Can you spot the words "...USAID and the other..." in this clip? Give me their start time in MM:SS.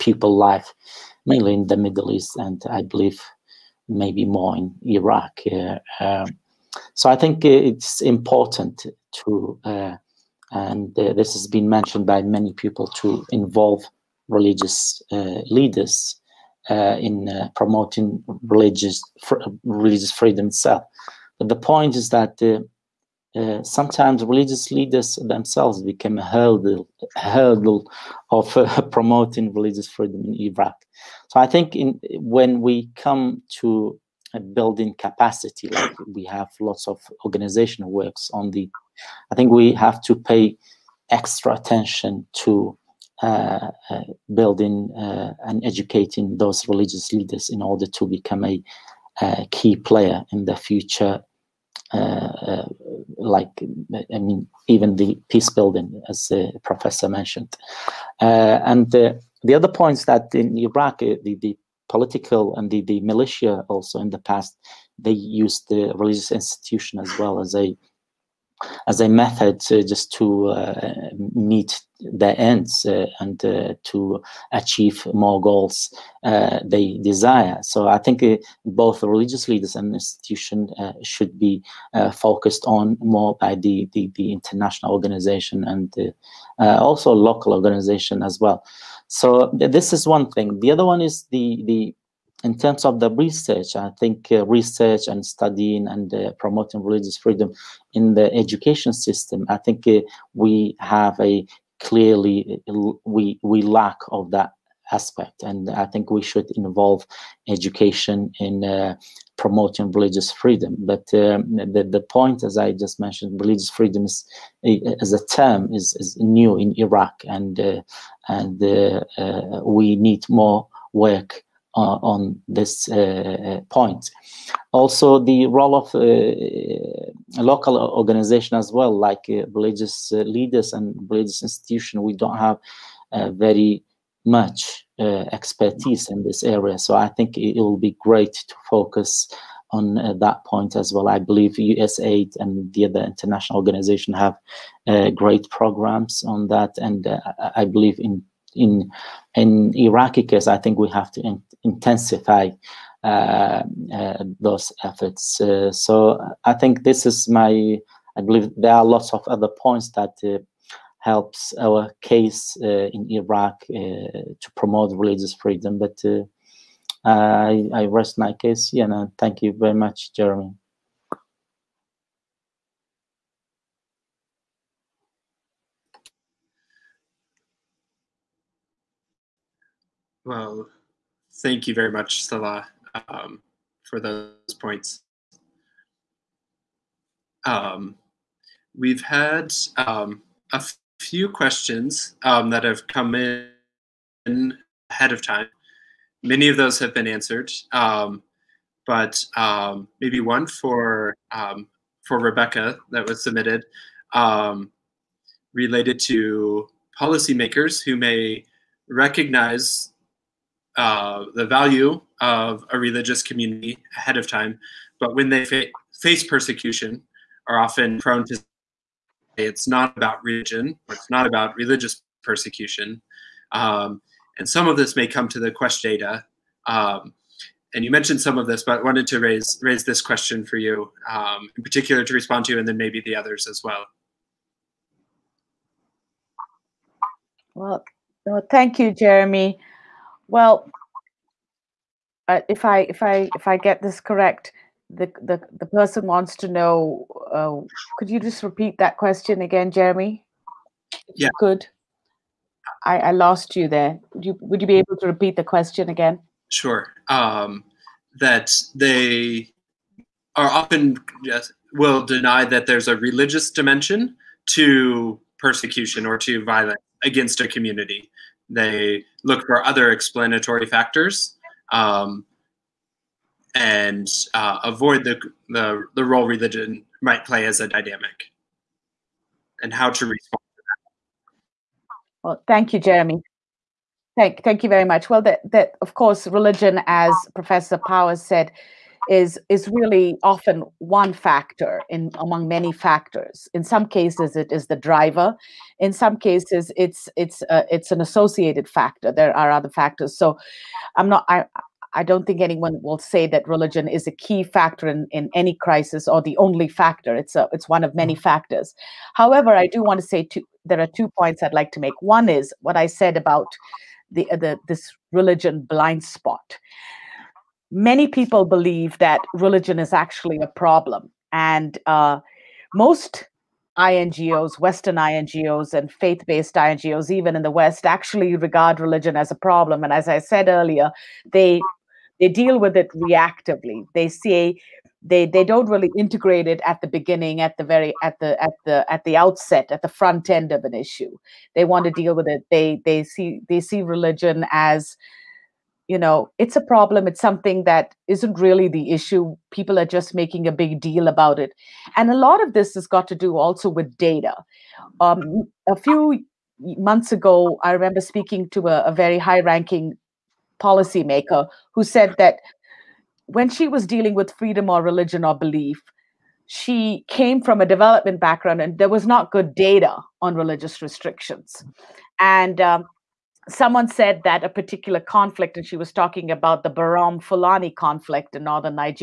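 02:21.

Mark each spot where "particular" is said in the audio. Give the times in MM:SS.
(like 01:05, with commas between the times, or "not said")
03:51, 06:14.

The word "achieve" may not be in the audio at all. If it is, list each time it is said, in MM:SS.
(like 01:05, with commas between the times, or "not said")
01:14.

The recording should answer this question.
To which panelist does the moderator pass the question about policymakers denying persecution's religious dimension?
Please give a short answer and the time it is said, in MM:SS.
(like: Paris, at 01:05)
Rebecca, at 03:22.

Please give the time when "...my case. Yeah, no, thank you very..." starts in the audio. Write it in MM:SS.
02:48.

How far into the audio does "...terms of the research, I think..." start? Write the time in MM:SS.
01:32.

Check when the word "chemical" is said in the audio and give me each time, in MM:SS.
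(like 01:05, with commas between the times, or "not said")
not said.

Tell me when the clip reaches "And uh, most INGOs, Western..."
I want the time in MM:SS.
05:21.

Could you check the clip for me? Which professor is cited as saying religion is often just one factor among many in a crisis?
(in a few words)
Professor Powers.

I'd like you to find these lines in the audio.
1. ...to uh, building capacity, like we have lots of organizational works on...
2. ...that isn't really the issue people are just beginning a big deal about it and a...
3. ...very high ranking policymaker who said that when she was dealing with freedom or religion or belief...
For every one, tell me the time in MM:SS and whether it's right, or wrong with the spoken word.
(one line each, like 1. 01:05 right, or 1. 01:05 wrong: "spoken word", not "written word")
1. 00:33 right
2. 05:47 wrong: "making", not "beginning"
3. 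05:58 right.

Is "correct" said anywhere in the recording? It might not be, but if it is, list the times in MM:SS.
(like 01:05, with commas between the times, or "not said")
04:03.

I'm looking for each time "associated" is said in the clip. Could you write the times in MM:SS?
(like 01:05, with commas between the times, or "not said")
04:57.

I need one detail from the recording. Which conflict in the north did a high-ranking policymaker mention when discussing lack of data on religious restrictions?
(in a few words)
Berom Fulani conflict.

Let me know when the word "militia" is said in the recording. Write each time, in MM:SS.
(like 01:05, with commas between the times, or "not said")
01:03.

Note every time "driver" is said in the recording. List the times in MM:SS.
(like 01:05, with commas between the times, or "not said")
04:54.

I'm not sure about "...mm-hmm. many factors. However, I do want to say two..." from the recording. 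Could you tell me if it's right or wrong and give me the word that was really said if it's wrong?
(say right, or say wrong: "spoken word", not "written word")
right.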